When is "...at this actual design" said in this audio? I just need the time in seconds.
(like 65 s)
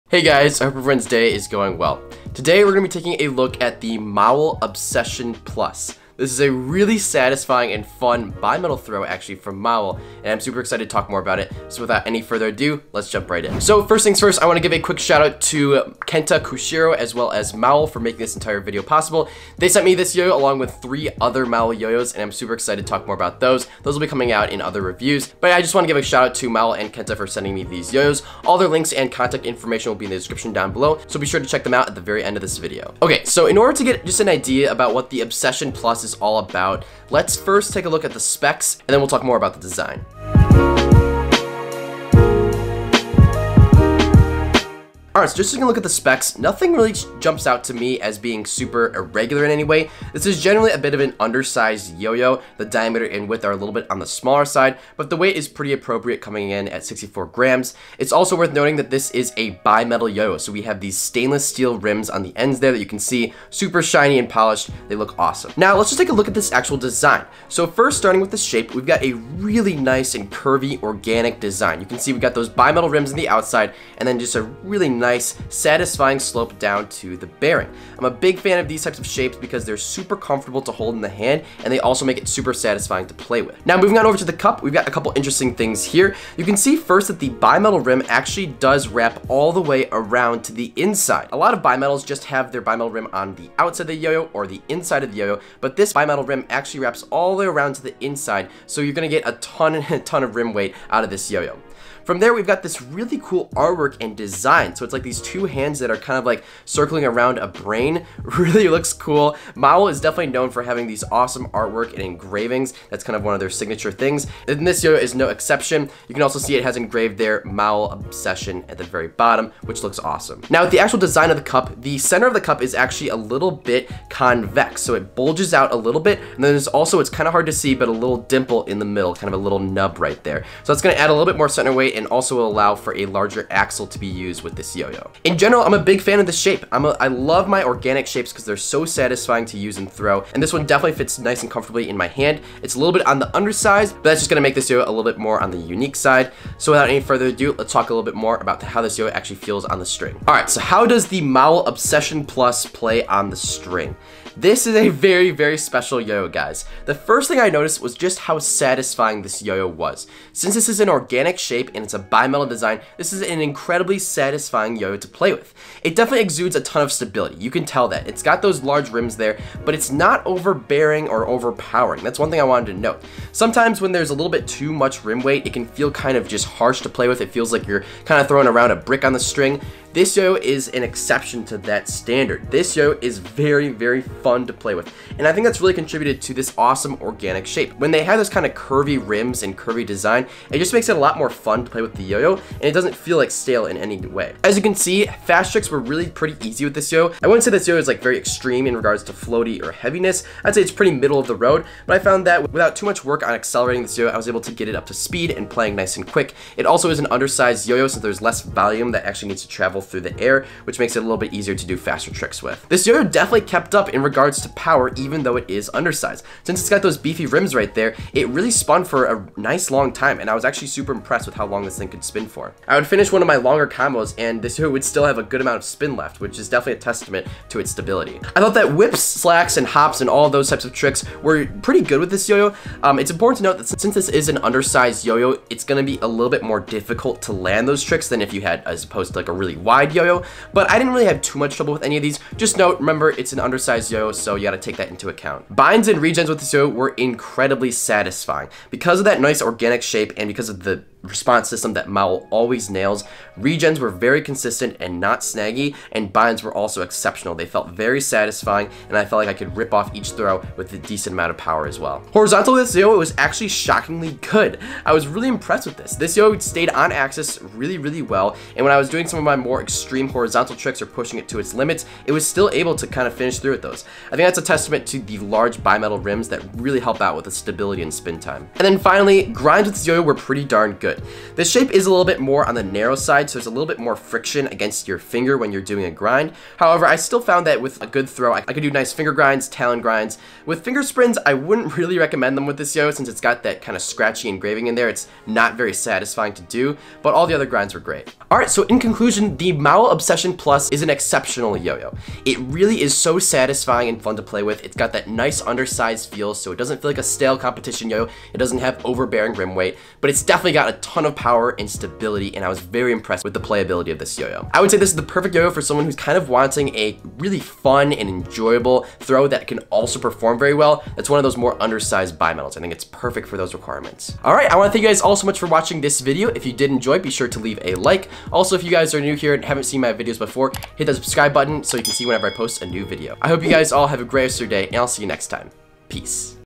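66 s.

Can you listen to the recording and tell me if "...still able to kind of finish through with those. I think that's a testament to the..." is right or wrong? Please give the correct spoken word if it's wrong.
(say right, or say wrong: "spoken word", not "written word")
right.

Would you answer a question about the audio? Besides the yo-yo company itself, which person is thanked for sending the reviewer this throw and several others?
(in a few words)
Kenta Kushiro.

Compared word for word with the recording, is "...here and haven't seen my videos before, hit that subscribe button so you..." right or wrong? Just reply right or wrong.
right.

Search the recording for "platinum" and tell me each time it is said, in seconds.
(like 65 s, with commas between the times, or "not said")
not said.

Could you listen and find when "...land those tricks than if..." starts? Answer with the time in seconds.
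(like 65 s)
237 s.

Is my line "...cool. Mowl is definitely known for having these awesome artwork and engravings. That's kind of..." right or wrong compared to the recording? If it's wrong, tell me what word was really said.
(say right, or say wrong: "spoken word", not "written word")
right.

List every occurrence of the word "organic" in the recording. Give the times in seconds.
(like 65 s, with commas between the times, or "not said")
70 s, 137 s, 160 s, 187 s, 249 s.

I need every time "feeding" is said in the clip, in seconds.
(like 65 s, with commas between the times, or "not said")
not said.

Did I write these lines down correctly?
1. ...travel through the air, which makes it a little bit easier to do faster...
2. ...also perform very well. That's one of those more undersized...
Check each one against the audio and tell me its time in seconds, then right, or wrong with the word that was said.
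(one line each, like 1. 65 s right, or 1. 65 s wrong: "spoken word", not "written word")
1. 209 s right
2. 319 s right.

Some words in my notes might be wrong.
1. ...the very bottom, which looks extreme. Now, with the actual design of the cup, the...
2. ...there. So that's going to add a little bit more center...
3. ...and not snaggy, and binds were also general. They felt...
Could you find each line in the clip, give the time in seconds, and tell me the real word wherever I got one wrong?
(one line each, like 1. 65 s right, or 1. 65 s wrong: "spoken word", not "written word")
1. 118 s wrong: "awesome", not "extreme"
2. 130 s right
3. 254 s wrong: "exceptional", not "general".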